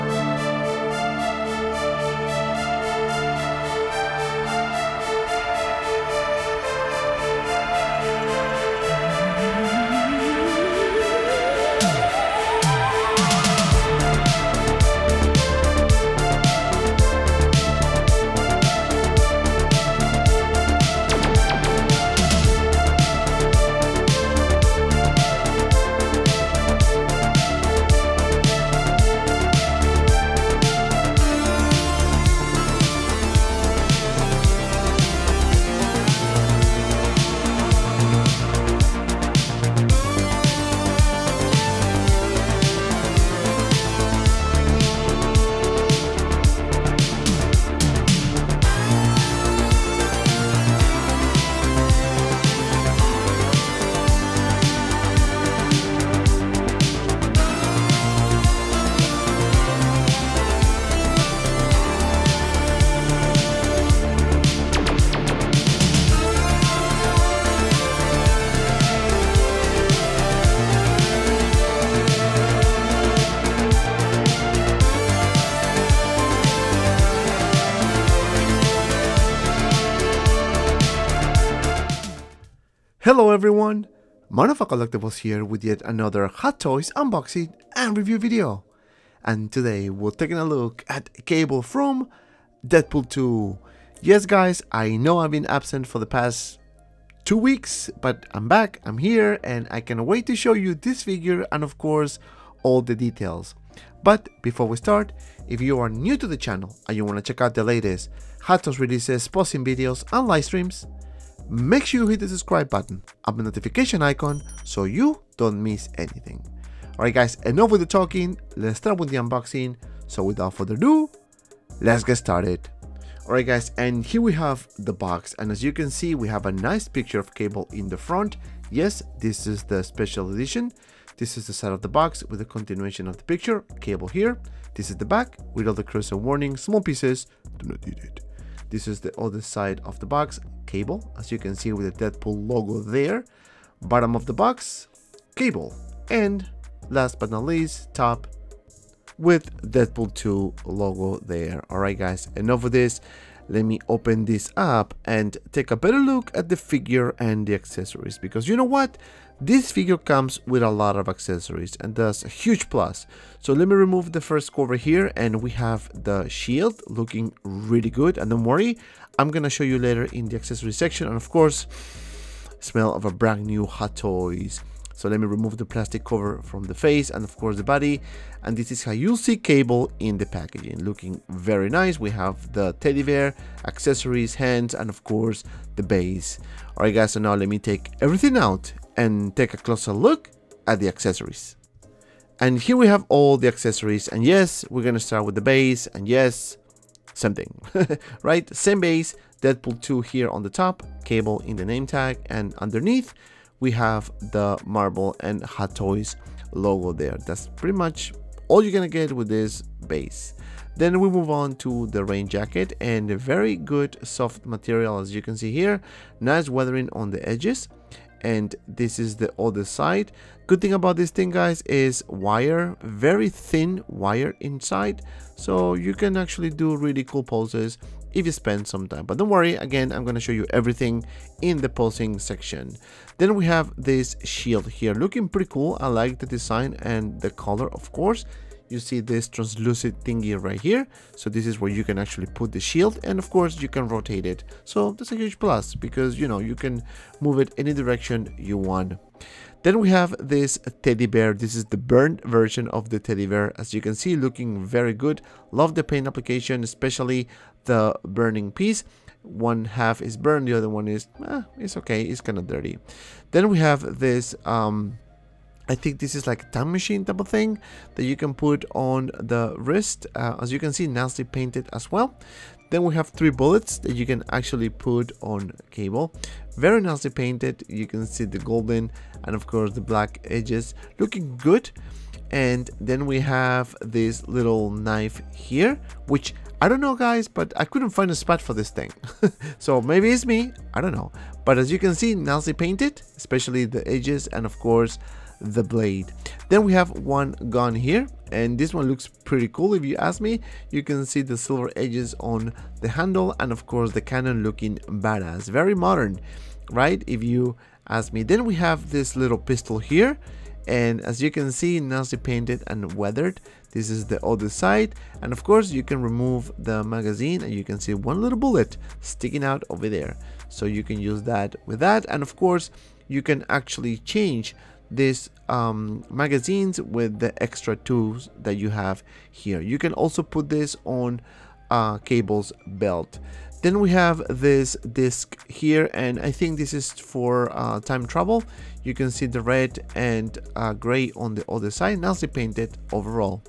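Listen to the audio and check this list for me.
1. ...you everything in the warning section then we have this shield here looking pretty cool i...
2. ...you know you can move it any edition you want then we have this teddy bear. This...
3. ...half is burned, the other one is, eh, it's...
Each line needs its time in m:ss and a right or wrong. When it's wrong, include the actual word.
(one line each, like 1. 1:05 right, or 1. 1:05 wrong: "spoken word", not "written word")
1. 3:50 wrong: "posing", not "warning"
2. 4:06 wrong: "direction", not "edition"
3. 4:19 right.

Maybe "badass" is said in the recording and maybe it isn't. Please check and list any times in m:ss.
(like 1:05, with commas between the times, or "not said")
5:04.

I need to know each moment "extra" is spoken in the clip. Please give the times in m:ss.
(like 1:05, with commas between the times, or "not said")
5:27.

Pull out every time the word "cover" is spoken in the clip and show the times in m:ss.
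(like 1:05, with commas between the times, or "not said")
2:44, 2:56.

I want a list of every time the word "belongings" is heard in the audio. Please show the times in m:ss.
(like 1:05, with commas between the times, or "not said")
not said.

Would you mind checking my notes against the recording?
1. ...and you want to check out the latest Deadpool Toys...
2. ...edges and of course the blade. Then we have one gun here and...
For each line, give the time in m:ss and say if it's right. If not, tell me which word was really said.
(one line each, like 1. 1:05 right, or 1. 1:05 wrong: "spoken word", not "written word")
1. 1:46 wrong: "Hot", not "Deadpool"
2. 4:53 right.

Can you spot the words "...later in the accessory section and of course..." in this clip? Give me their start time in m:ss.
2:49.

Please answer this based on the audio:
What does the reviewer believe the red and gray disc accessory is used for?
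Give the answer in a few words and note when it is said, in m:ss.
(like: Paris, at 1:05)
Time travel, at 5:37.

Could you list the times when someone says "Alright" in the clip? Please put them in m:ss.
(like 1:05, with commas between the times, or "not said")
1:56, 2:03, 2:31, 3:06.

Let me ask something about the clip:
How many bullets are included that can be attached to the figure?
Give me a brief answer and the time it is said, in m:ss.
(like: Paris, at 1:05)
3, at 4:33.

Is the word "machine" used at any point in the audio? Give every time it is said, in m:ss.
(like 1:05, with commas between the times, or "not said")
4:26.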